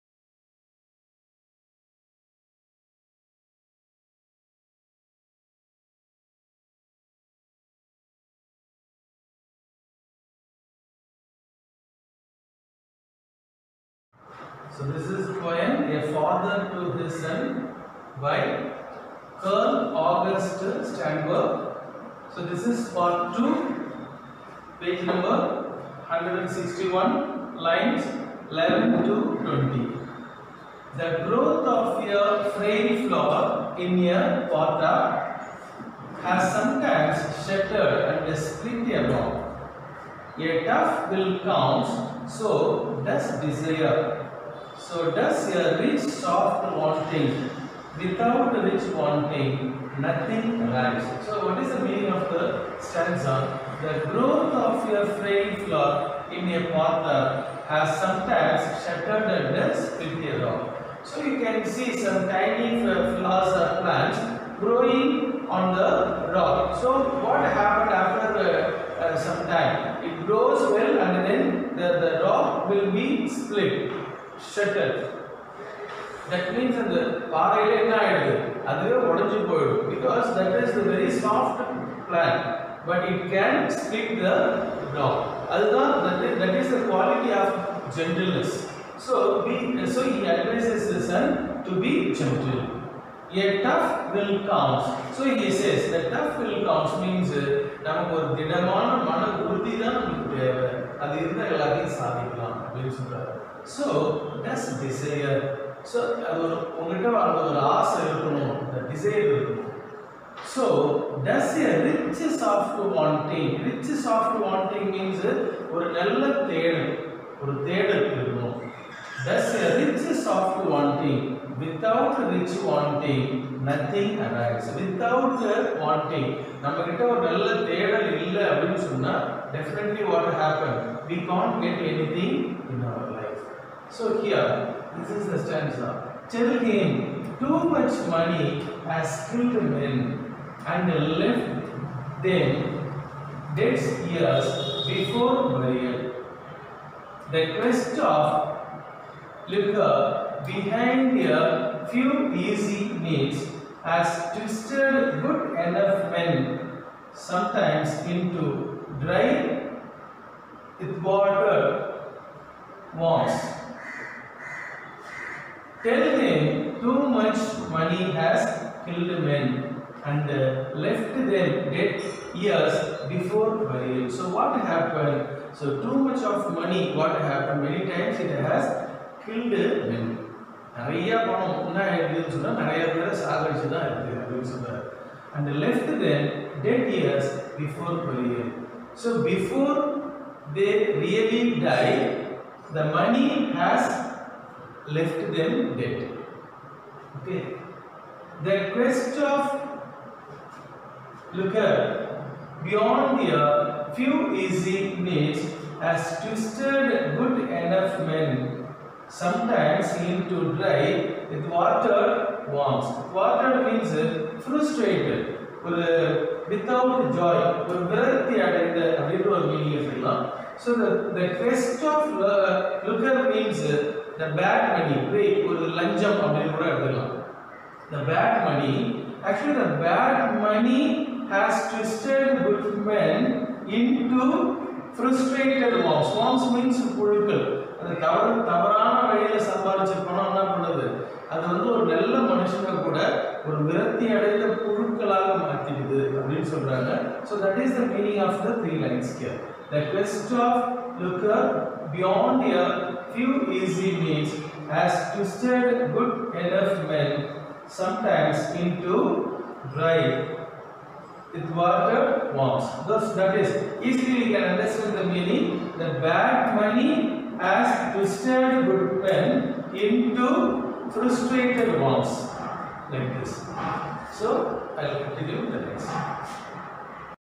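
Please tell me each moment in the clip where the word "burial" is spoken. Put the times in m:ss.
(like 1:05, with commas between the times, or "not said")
2:25, 2:53.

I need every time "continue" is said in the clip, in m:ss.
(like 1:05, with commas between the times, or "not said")
4:35.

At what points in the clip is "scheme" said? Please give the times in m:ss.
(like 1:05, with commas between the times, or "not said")
not said.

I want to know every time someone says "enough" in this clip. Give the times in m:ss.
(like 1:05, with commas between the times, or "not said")
2:35, 3:27, 4:16.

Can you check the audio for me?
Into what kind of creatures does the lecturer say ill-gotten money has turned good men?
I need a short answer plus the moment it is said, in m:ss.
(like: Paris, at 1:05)
frustrated worms, at 4:30.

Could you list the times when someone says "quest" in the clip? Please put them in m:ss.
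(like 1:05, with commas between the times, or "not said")
2:27, 3:18, 4:09.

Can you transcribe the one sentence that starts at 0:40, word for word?
A tough will counts, so does desire.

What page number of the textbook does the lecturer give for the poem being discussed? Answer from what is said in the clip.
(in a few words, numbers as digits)
161.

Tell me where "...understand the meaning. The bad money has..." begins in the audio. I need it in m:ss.
4:24.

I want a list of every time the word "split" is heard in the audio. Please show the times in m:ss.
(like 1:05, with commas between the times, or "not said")
0:38, 1:13.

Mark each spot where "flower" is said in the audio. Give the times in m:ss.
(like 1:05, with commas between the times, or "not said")
0:33, 0:55, 1:02.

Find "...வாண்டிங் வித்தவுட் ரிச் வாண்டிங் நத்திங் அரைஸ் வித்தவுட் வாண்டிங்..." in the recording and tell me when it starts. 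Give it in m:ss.
2:00.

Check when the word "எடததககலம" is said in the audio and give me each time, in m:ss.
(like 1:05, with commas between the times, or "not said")
3:39, 3:46.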